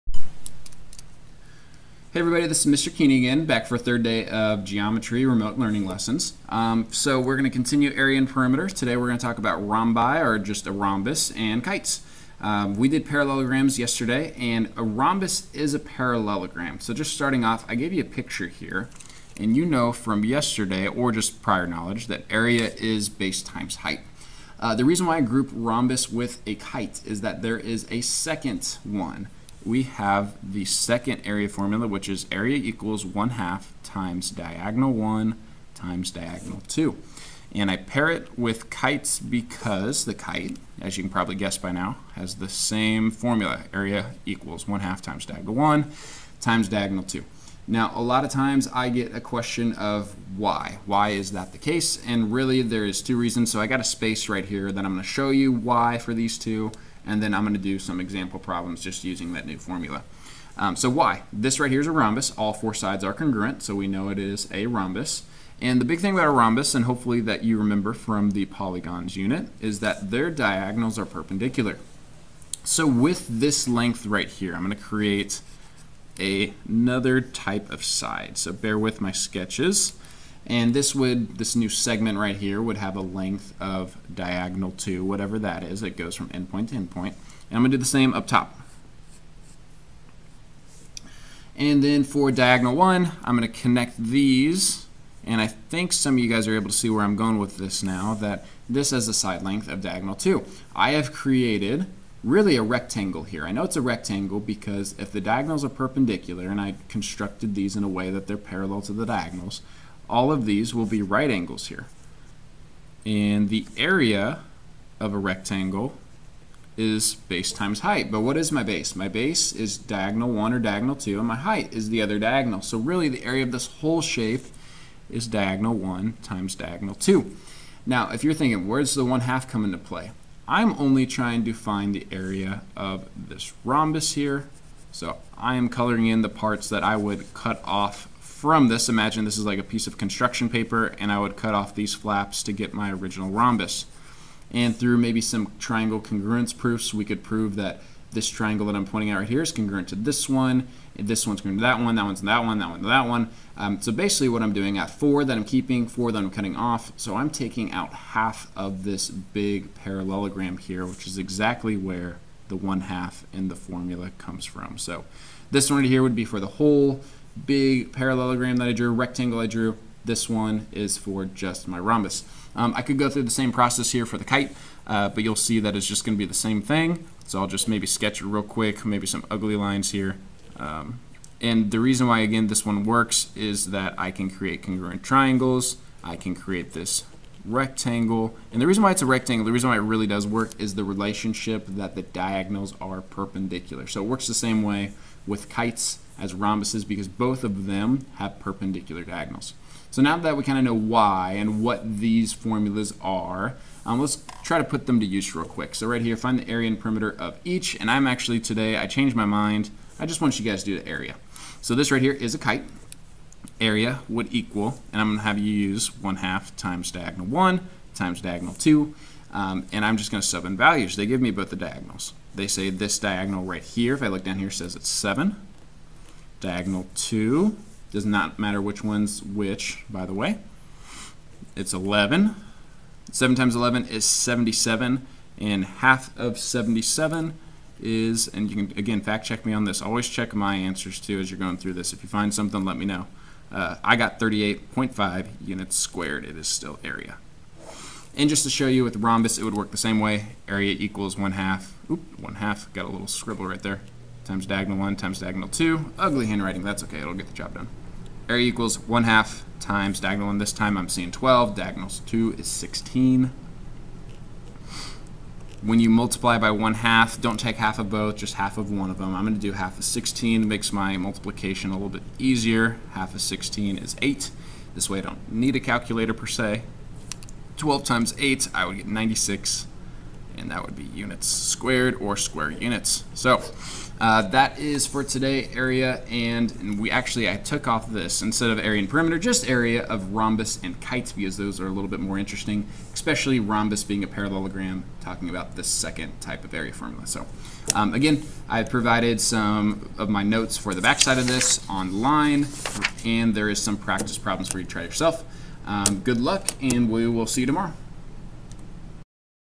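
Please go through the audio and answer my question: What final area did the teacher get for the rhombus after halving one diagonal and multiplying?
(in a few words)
96.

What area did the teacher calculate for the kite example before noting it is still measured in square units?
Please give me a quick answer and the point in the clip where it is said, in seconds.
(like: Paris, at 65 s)
38.5 units squared, at 244 s.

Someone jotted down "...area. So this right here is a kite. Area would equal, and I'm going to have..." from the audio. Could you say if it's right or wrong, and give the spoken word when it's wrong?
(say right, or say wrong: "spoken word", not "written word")
right.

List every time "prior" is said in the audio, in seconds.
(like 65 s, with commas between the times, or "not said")
21 s.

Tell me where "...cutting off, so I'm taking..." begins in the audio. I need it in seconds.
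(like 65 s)
156 s.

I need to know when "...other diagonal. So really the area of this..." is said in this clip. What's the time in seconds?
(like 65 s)
122 s.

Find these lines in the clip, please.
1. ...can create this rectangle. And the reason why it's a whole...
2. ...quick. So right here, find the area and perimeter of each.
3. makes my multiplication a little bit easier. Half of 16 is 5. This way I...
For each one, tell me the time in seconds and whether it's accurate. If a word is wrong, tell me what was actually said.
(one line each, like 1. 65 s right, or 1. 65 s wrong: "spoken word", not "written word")
1. 186 s wrong: "rectangle", not "whole"
2. 205 s right
3. 270 s wrong: "8", not "5".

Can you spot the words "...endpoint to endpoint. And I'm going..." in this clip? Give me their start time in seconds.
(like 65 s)
86 s.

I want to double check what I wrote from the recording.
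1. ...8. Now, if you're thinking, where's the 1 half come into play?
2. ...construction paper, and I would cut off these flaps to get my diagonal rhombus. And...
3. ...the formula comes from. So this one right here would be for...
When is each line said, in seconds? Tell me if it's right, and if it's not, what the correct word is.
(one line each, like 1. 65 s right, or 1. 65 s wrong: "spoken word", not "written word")
1. 126 s wrong: "2", not "8"
2. 139 s wrong: "original", not "diagonal"
3. 163 s right.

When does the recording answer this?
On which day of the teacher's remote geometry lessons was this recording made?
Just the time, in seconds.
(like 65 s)
3 s.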